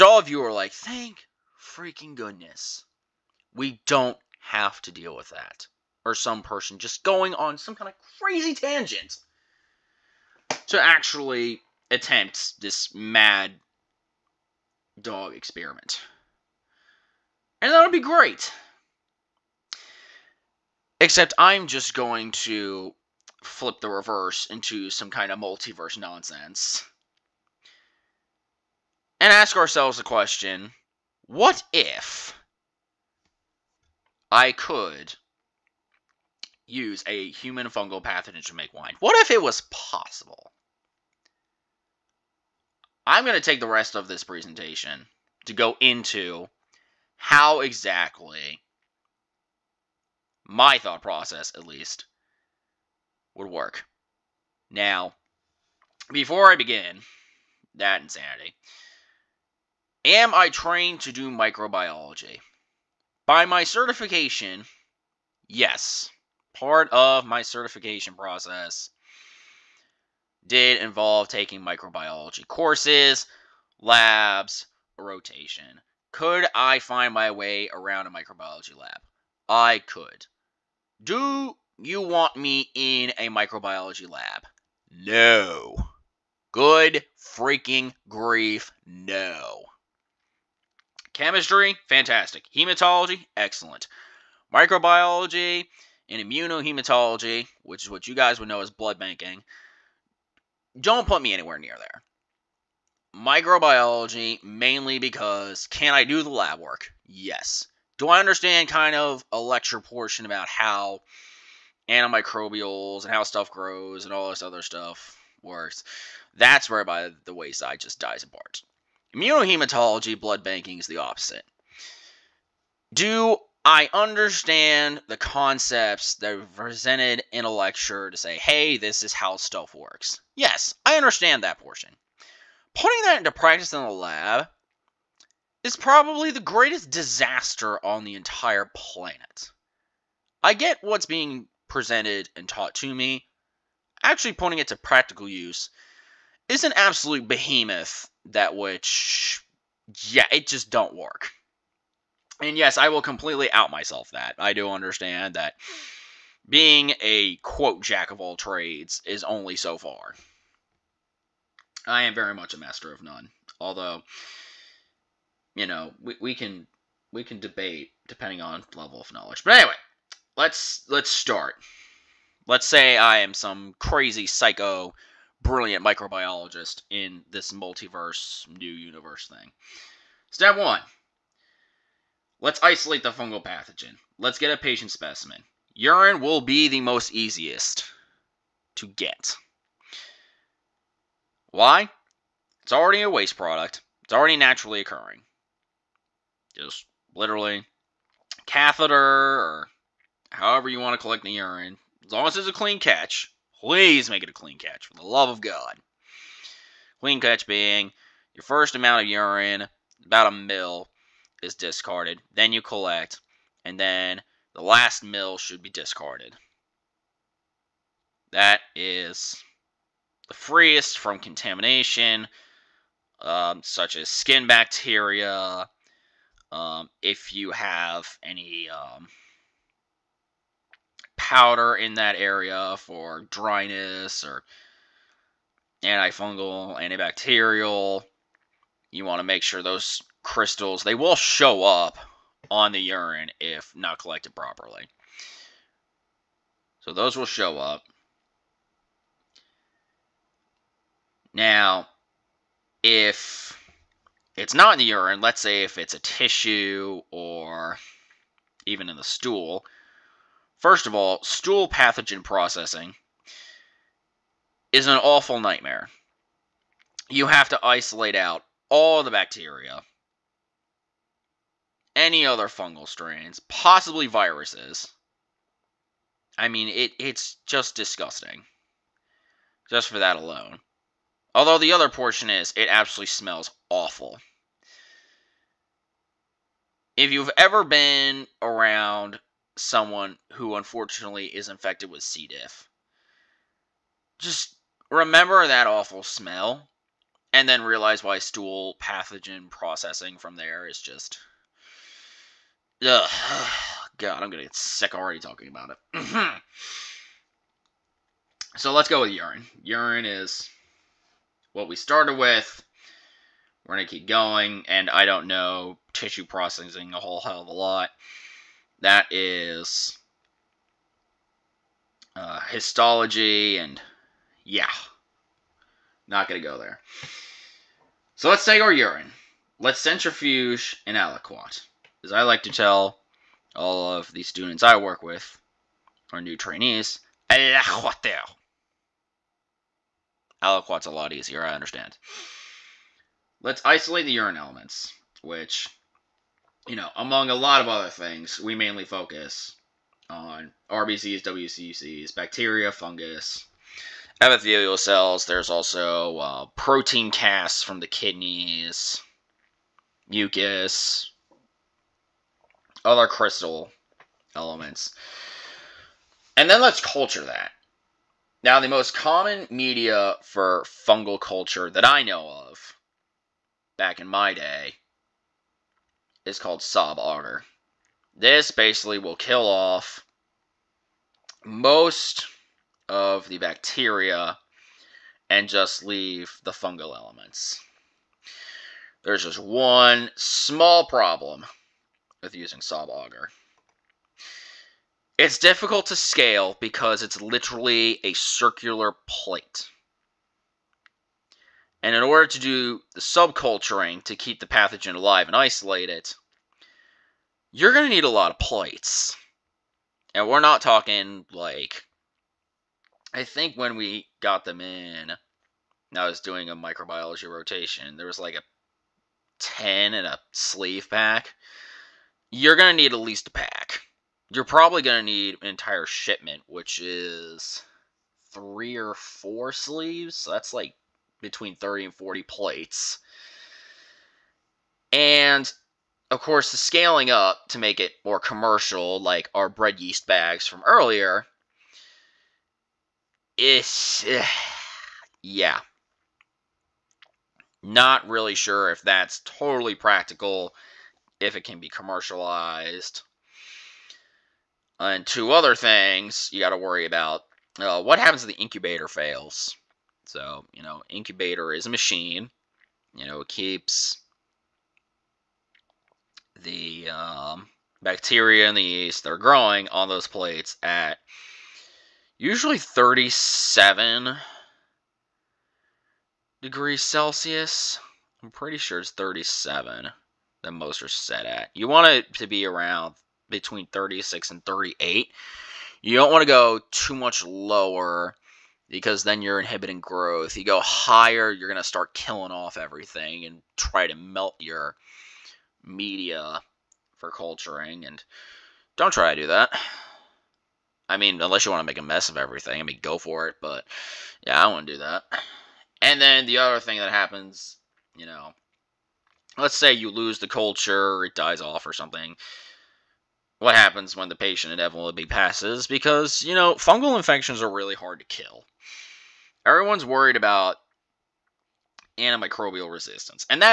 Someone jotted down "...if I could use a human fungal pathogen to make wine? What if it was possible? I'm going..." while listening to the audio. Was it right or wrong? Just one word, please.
right.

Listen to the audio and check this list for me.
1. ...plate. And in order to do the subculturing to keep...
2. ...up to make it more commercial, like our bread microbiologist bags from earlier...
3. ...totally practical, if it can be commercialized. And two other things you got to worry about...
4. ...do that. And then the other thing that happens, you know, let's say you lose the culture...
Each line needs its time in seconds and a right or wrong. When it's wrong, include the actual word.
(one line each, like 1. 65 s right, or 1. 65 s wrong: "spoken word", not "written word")
1. 399 s right
2. 437 s wrong: "yeast", not "microbiologist"
3. 449 s right
4. 504 s right.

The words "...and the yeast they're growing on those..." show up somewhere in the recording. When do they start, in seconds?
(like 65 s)
468 s.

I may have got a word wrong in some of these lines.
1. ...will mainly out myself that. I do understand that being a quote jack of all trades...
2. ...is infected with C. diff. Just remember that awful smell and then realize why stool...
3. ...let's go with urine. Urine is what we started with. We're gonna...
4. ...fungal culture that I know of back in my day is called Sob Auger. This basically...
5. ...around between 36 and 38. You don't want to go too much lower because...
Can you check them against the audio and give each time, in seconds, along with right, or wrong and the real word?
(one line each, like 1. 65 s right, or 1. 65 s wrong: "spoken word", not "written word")
1. 152 s wrong: "completely", not "mainly"
2. 291 s right
3. 308 s right
4. 370 s right
5. 482 s right.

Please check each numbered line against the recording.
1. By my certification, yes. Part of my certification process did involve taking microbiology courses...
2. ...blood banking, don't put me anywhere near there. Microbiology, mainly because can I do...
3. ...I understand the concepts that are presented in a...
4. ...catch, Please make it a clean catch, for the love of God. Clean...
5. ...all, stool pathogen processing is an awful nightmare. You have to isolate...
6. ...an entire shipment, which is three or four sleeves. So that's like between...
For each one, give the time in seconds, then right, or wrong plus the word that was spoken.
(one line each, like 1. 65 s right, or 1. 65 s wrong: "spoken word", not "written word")
1. 63 s right
2. 98 s right
3. 123 s right
4. 202 s right
5. 260 s right
6. 425 s right.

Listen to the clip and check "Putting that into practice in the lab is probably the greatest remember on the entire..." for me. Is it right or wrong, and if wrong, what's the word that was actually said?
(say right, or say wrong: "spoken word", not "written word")
wrong: "disaster", not "remember".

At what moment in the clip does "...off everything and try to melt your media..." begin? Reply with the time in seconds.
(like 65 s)
492 s.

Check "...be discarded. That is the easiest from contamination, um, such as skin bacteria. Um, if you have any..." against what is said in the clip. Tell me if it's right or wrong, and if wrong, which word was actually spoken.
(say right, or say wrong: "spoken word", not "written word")
wrong: "freest", not "easiest".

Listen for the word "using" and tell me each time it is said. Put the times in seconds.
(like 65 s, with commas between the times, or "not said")
392 s.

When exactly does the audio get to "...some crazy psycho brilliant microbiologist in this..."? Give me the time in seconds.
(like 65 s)
173 s.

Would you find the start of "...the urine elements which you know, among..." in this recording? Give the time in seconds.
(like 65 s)
344 s.